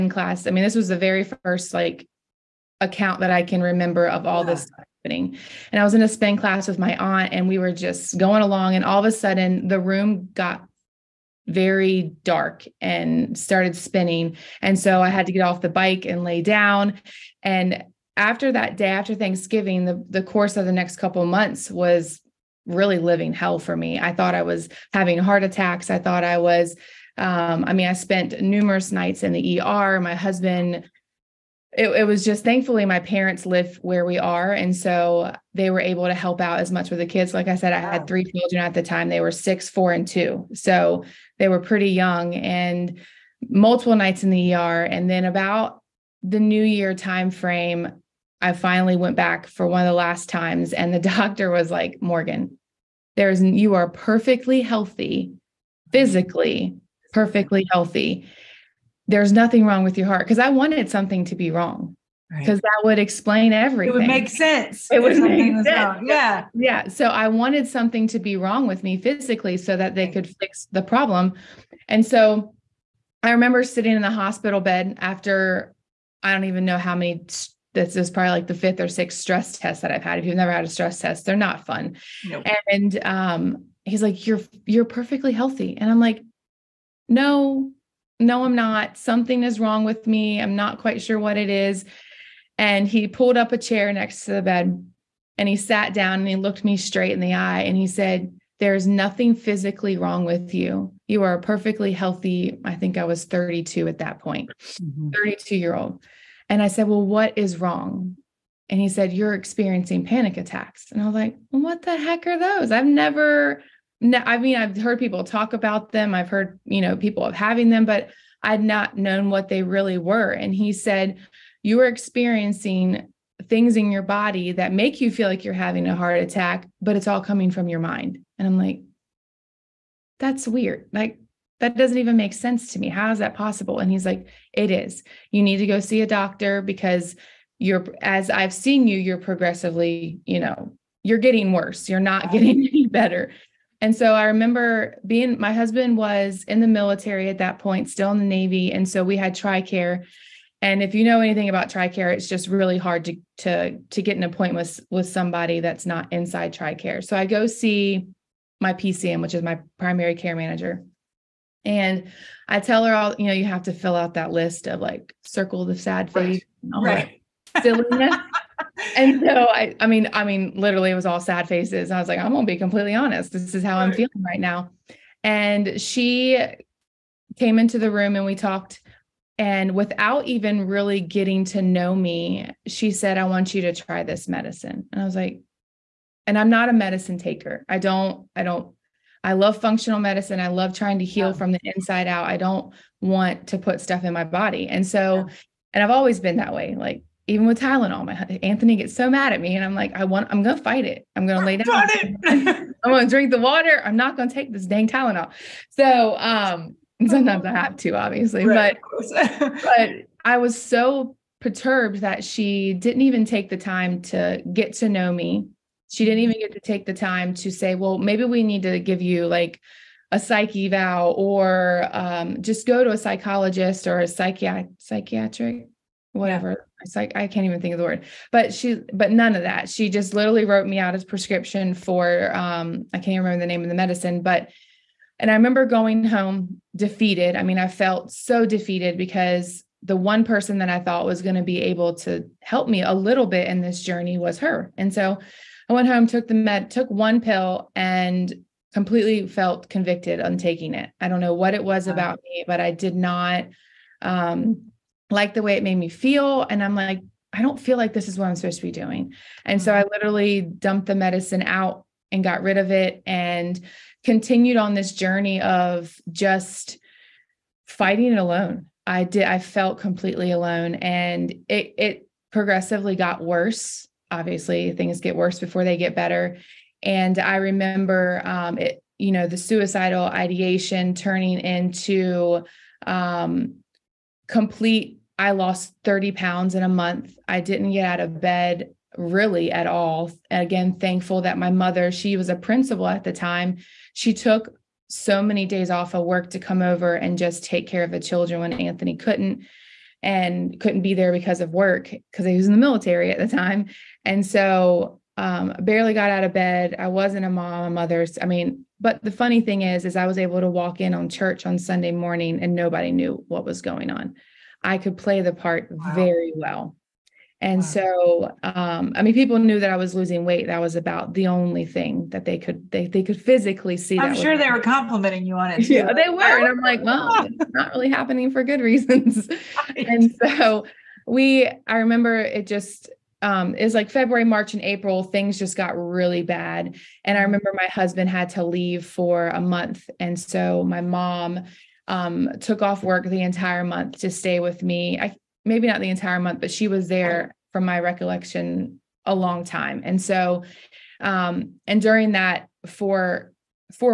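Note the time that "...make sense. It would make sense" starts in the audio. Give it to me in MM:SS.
01:04.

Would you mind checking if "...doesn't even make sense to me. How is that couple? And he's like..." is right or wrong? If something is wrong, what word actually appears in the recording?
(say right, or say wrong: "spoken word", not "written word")
wrong: "possible", not "couple".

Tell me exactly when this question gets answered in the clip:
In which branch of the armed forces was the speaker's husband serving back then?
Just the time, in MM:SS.
02:28.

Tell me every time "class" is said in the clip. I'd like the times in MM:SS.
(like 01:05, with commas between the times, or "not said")
00:00, 00:06.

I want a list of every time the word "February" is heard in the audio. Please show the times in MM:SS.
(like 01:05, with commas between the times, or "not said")
05:33.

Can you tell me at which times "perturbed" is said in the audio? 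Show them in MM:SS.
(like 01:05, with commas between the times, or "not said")
03:31.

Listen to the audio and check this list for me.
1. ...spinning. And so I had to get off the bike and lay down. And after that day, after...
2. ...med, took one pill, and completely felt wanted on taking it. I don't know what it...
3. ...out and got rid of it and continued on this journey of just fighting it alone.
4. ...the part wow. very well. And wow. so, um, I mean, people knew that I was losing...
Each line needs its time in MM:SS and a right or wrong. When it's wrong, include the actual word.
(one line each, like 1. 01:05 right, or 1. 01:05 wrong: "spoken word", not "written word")
1. 00:13 right
2. 04:06 wrong: "convicted", not "wanted"
3. 04:21 right
4. 05:15 right.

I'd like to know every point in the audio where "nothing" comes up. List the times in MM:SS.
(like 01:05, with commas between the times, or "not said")
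00:59, 01:38.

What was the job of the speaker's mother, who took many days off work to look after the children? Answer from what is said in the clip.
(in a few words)
Principal.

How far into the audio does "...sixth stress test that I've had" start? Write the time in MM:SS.
01:18.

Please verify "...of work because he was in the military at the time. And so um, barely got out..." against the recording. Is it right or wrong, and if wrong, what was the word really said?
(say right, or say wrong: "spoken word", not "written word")
right.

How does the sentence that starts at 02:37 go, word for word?
So I go see my PCM, which is my primary care manager.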